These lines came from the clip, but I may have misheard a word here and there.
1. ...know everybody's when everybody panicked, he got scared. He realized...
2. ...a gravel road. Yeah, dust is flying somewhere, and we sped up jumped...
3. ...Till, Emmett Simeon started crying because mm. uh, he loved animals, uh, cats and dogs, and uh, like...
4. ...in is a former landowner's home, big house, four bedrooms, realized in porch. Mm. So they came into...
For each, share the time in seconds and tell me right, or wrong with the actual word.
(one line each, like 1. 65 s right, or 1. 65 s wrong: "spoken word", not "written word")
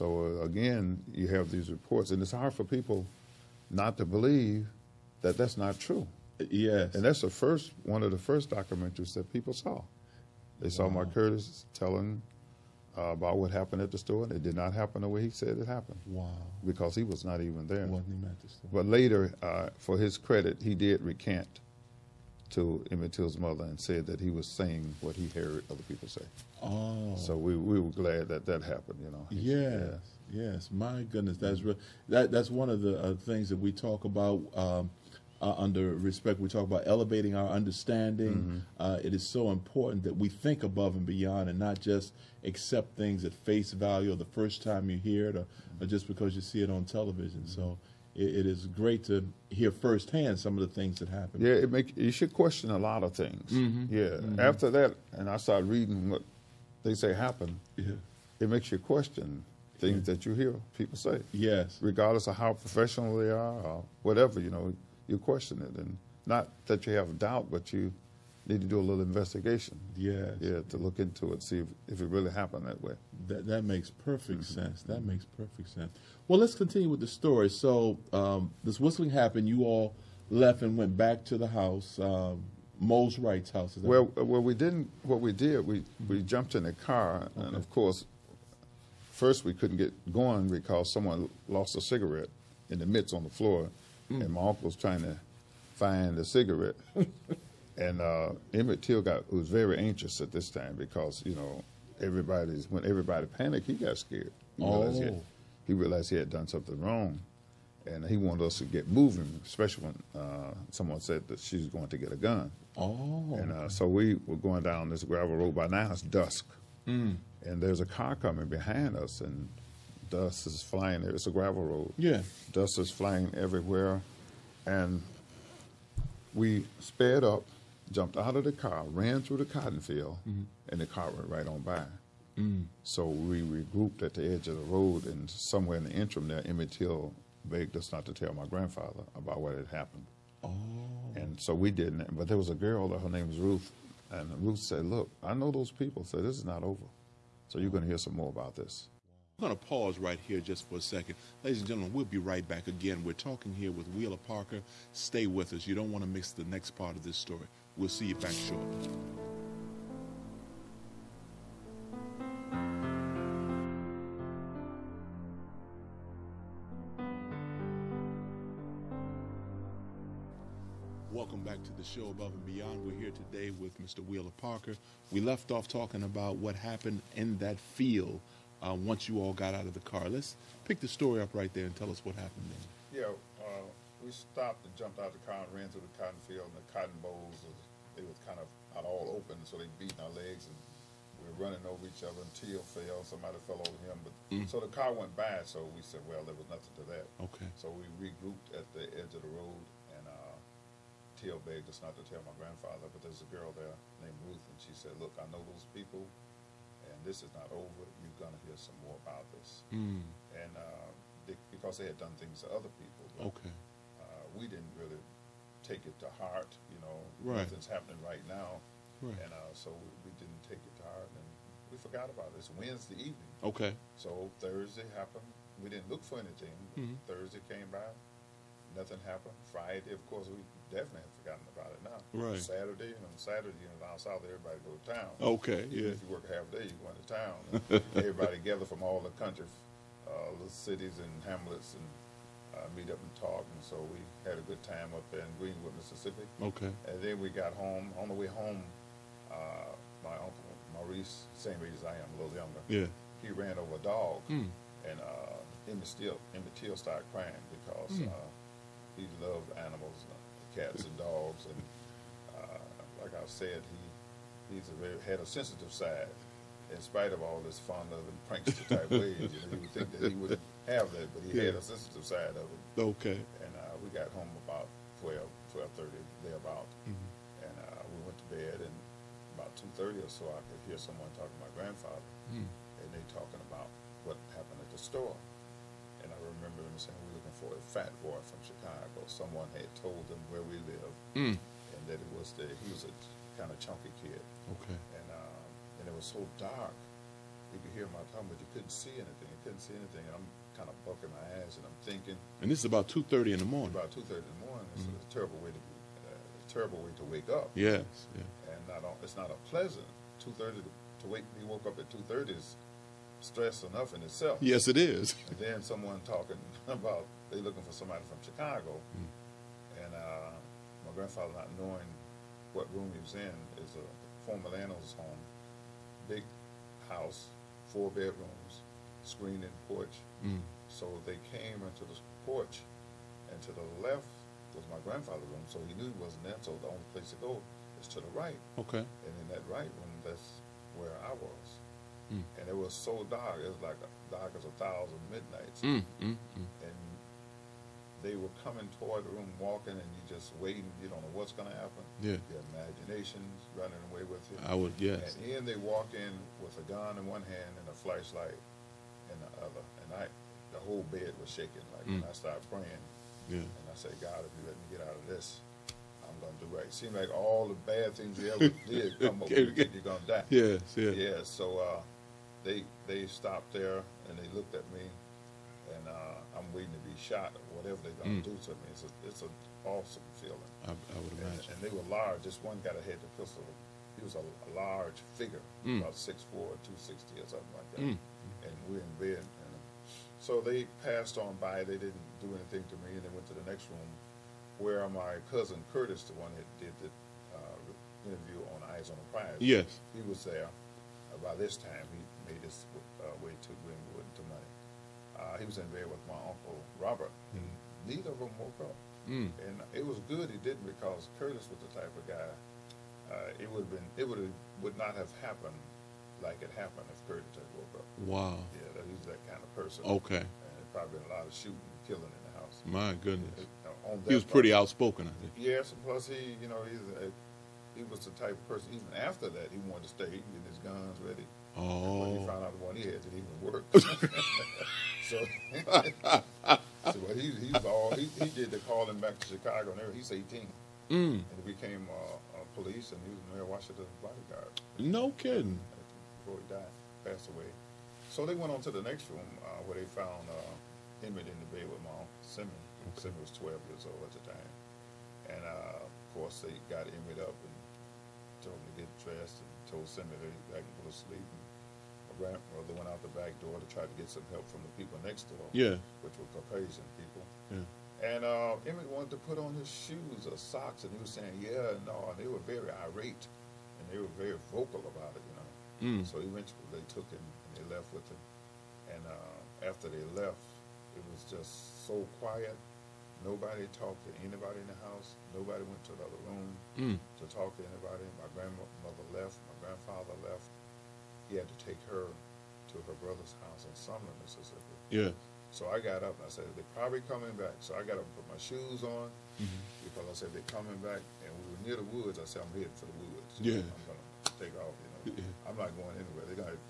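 1. 101 s right
2. 121 s wrong: "everywhere", not "somewhere"
3. 255 s wrong: "Till", not "Simeon"
4. 323 s wrong: "screened", not "realized".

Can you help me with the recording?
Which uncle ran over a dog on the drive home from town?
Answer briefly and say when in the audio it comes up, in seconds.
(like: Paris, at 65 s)
Maurice, at 250 s.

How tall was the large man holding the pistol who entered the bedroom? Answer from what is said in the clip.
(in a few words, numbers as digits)
6'4".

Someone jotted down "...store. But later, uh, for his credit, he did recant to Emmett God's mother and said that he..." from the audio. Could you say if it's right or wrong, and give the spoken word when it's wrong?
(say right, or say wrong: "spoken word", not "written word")
wrong: "Till", not "God".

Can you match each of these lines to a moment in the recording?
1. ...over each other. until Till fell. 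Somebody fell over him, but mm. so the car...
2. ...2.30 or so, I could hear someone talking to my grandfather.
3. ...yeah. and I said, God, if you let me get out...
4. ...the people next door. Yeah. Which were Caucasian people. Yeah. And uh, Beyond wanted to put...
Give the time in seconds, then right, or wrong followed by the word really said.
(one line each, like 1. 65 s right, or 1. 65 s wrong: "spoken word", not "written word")
1. 191 s right
2. 279 s right
3. 363 s right
4. 464 s wrong: "Emmett", not "Beyond".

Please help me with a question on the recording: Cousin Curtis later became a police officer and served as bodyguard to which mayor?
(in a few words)
Mayor Washington.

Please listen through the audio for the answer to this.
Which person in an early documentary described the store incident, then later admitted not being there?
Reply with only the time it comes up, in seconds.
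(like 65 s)
10 s.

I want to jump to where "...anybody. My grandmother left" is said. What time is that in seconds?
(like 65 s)
487 s.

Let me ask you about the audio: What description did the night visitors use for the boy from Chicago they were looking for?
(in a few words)
fat boy.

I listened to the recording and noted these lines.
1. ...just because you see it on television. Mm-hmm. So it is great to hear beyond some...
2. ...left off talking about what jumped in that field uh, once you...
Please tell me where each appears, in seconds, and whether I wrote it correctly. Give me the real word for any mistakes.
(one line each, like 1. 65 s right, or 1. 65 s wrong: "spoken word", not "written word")
1. 45 s wrong: "firsthand", not "beyond"
2. 175 s wrong: "happened", not "jumped".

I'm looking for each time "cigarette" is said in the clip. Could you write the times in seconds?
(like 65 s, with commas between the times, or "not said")
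91 s, 96 s.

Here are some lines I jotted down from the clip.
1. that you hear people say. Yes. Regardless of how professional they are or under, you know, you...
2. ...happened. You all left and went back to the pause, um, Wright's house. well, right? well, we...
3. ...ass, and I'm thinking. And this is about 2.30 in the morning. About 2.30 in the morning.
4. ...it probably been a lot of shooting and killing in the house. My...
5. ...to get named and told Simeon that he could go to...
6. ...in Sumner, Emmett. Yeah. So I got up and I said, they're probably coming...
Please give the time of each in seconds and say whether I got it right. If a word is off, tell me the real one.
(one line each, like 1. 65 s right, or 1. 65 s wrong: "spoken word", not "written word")
1. 60 s wrong: "whatever", not "under"
2. 79 s wrong: "house", not "pause"
3. 301 s right
4. 420 s right
5. 458 s wrong: "dressed", not "named"
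6. 493 s wrong: "Mississippi", not "Emmett".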